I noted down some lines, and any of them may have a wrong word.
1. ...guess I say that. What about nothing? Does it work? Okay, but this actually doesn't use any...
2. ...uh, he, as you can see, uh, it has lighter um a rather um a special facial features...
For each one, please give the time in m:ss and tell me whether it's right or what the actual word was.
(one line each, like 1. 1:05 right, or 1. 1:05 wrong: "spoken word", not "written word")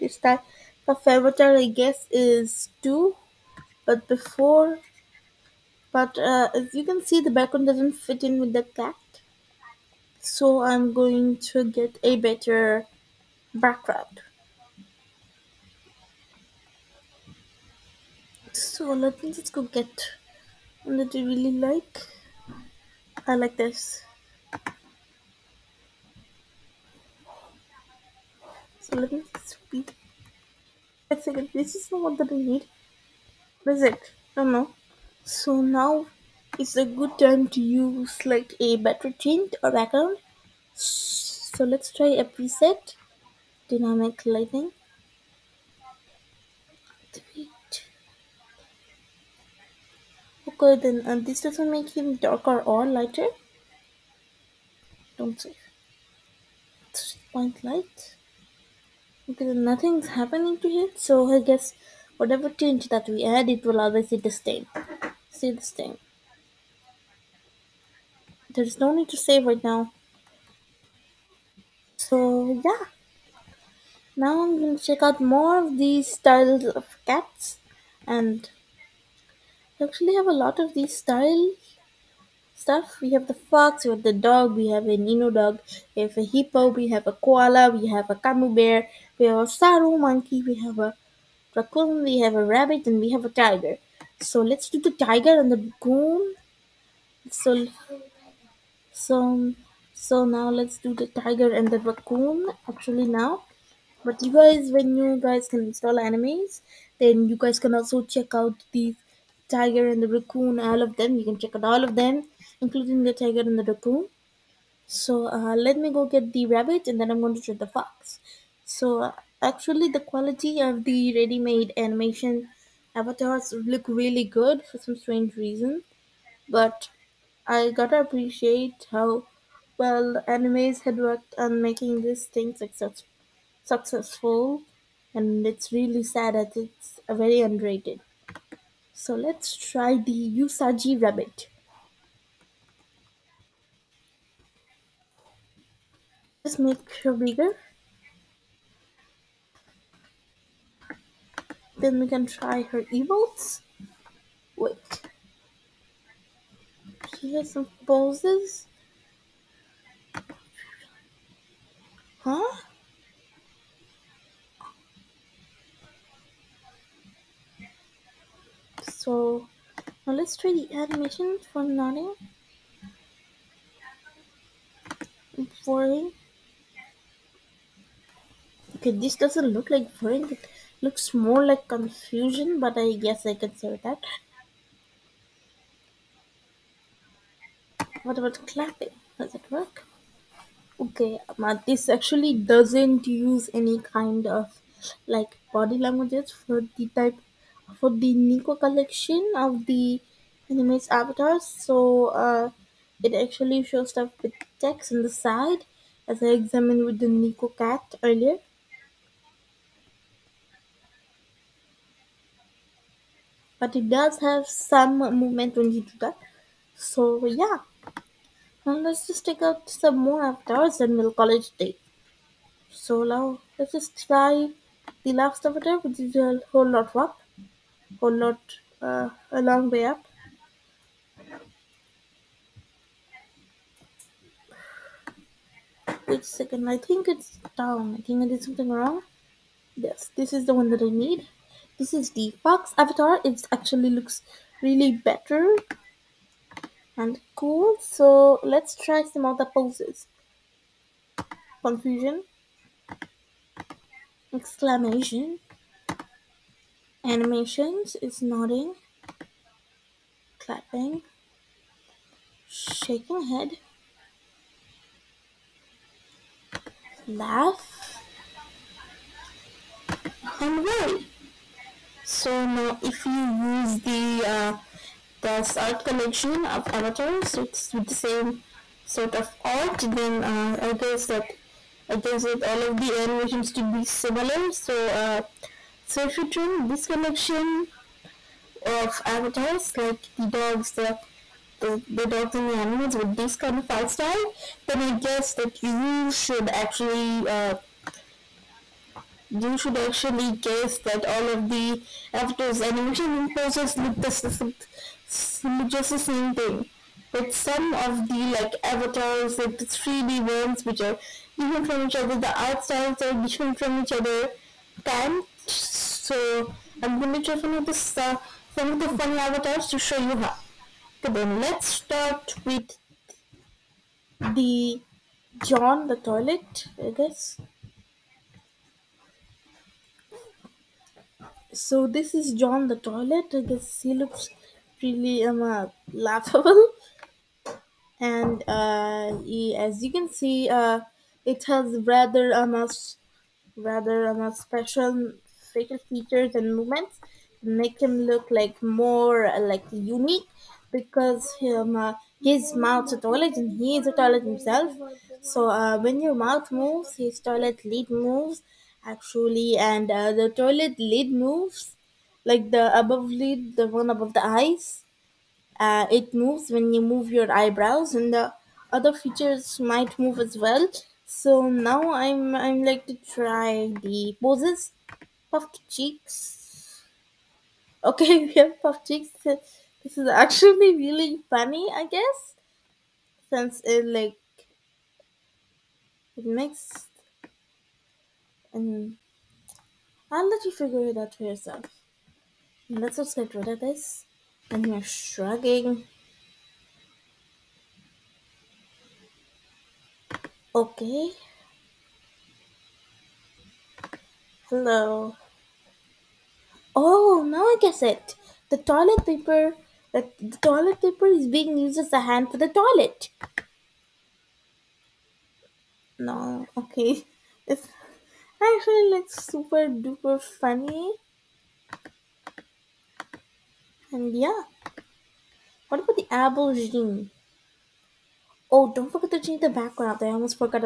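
1. 3:02 wrong: "clapping", not "nothing"
2. 5:38 wrong: "rather", not "lighter".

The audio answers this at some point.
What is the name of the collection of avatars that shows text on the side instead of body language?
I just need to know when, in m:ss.
3:18.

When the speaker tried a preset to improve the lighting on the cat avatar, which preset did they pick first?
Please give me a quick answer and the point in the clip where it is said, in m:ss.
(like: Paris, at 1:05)
Dynamic lighting, at 0:43.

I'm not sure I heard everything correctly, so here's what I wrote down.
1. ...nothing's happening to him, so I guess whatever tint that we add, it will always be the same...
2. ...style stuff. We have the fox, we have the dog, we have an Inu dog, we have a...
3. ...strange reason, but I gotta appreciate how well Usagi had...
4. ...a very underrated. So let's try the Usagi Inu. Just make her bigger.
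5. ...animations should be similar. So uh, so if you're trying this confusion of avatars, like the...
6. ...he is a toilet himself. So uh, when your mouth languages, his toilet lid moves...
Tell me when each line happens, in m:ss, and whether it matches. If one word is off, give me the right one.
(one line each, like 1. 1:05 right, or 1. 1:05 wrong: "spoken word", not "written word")
1. 0:59 right
2. 1:21 right
3. 2:04 wrong: "Animaze", not "Usagi"
4. 2:17 wrong: "Rabbit", not "Inu"
5. 4:42 wrong: "collection", not "confusion"
6. 5:53 wrong: "moves", not "languages".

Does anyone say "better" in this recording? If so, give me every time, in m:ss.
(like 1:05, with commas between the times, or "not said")
0:12, 0:38, 4:04.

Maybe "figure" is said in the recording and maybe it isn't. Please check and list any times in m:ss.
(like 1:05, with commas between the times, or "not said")
6:30.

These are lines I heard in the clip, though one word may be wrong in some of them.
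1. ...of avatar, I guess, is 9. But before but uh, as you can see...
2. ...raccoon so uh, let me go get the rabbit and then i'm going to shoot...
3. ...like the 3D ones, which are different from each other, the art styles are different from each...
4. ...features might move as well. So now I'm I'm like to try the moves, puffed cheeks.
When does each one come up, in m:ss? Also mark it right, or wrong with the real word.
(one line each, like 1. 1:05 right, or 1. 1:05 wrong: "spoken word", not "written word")
1. 0:00 wrong: "2", not "9"
2. 1:53 right
3. 5:09 right
4. 6:08 wrong: "poses", not "moves".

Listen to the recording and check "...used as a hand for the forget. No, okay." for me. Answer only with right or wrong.
wrong.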